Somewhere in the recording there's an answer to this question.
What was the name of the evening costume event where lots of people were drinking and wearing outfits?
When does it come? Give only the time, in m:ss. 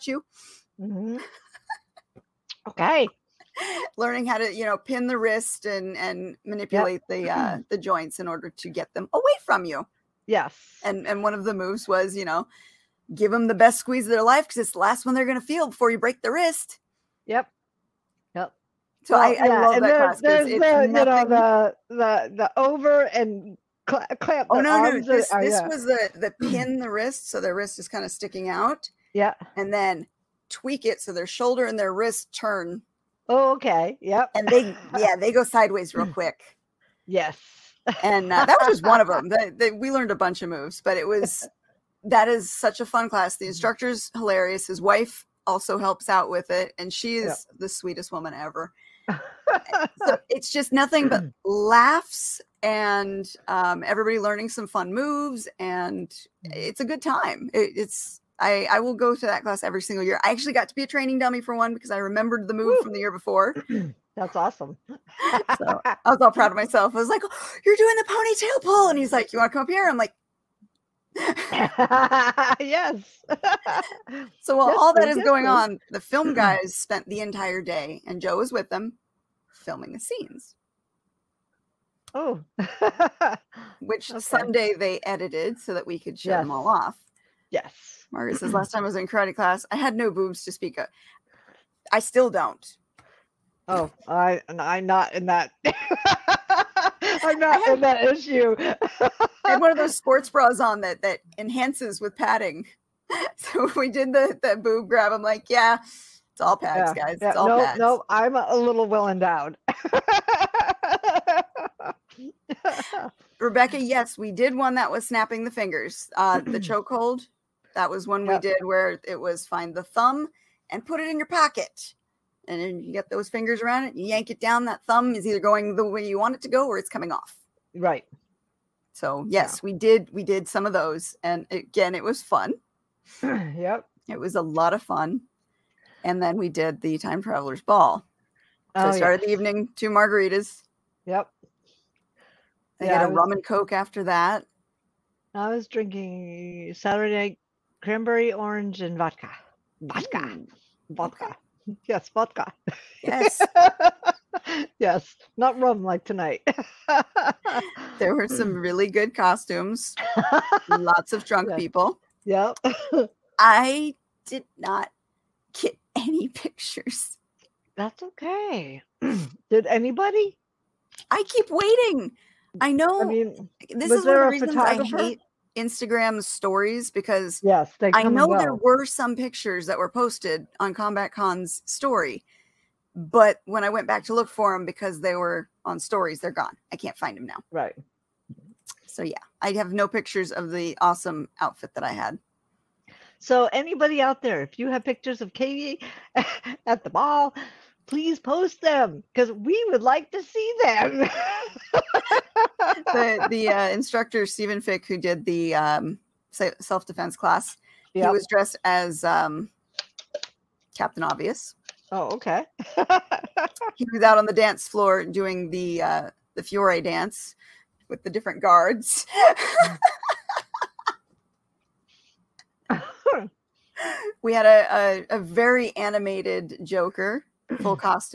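2:16.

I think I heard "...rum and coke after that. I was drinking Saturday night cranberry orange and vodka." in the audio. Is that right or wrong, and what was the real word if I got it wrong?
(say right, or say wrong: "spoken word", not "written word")
right.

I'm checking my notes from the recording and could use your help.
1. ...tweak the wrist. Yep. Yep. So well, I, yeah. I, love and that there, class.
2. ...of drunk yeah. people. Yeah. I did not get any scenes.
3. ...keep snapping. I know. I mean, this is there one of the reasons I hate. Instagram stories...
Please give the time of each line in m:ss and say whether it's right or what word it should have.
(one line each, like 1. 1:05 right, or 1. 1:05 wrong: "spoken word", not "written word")
1. 0:15 wrong: "break", not "tweak"
2. 2:41 wrong: "pictures", not "scenes"
3. 2:51 wrong: "waiting", not "snapping".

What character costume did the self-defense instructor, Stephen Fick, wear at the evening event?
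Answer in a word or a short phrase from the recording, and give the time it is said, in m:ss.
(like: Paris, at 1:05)
Captain Obvious, at 3:30.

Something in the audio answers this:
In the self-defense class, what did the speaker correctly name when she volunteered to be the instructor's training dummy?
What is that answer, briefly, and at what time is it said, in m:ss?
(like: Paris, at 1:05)
The ponytail pull, at 1:08.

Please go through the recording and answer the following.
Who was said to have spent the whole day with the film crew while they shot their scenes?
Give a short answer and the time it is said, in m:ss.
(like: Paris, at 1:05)
Joe, at 1:18.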